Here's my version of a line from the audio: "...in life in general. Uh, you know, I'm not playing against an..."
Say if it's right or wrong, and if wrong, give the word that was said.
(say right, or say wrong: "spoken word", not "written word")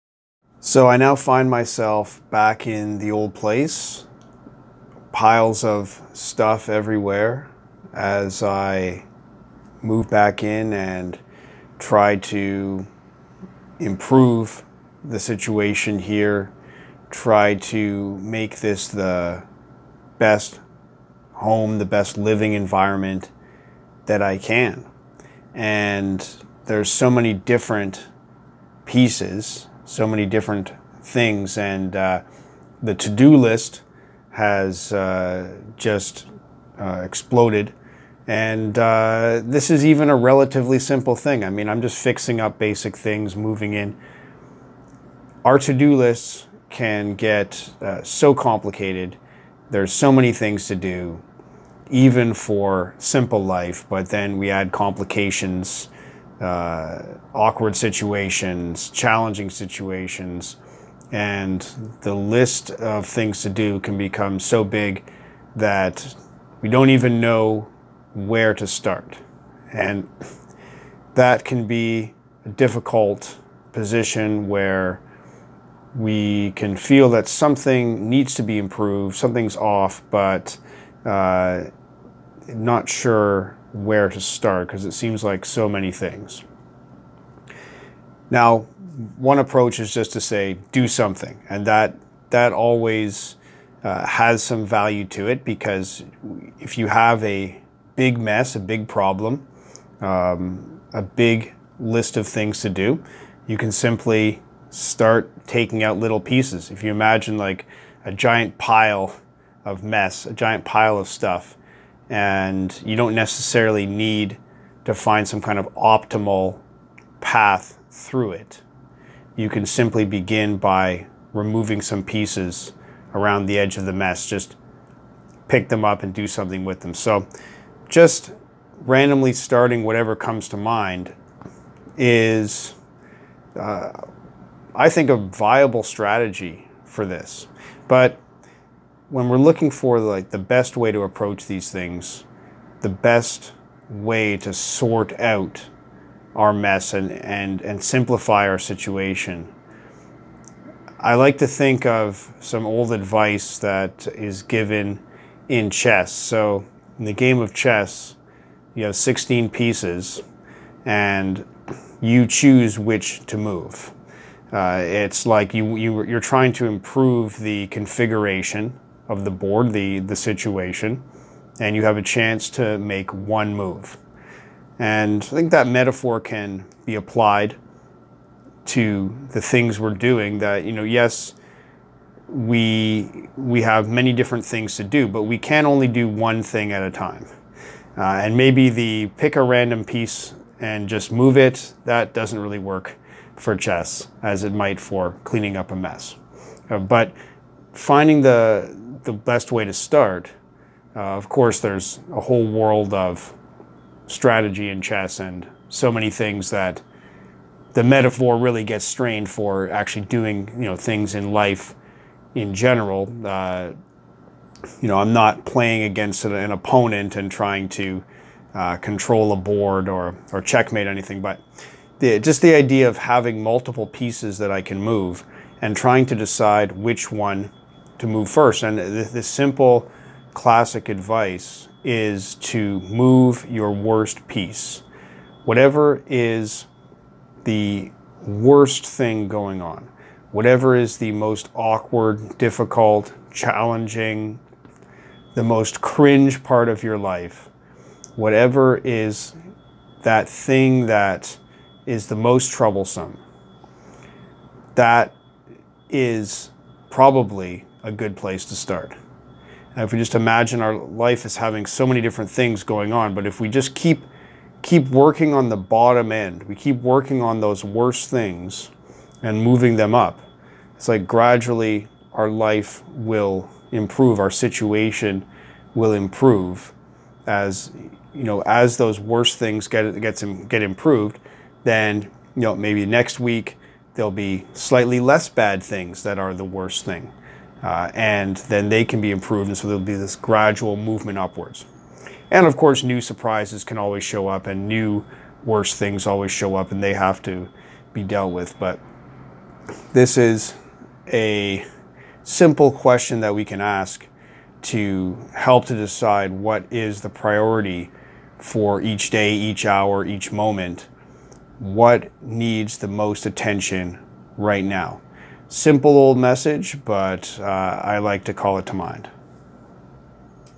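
right.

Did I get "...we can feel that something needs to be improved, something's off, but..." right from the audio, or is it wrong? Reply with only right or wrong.
right.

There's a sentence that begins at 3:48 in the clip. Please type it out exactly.
And the, the simple classic advice is to move your worst piece.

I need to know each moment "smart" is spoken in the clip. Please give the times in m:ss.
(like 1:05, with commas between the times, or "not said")
not said.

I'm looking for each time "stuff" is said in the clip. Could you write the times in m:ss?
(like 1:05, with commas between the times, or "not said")
0:06, 1:51.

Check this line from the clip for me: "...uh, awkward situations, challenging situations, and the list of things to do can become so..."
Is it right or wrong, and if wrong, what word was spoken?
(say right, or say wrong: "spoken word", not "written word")
right.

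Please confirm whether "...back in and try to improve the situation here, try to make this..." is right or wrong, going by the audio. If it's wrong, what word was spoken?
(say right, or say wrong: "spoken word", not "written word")
right.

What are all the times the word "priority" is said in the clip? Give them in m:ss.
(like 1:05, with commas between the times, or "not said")
5:07.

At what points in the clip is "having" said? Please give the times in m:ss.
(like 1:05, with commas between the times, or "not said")
3:42, 4:21.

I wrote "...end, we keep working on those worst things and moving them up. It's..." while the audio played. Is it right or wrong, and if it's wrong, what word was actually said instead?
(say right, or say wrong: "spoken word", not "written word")
right.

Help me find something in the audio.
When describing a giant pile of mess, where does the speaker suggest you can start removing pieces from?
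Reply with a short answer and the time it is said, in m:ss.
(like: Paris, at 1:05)
Around the edge, at 2:03.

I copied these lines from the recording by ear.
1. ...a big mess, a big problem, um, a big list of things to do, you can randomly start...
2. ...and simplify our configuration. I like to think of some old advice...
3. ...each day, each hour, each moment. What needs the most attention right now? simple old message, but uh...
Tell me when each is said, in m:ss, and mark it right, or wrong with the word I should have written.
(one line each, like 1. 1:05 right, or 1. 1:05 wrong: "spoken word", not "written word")
1. 1:37 wrong: "simply", not "randomly"
2. 2:27 wrong: "situation", not "configuration"
3. 5:08 right.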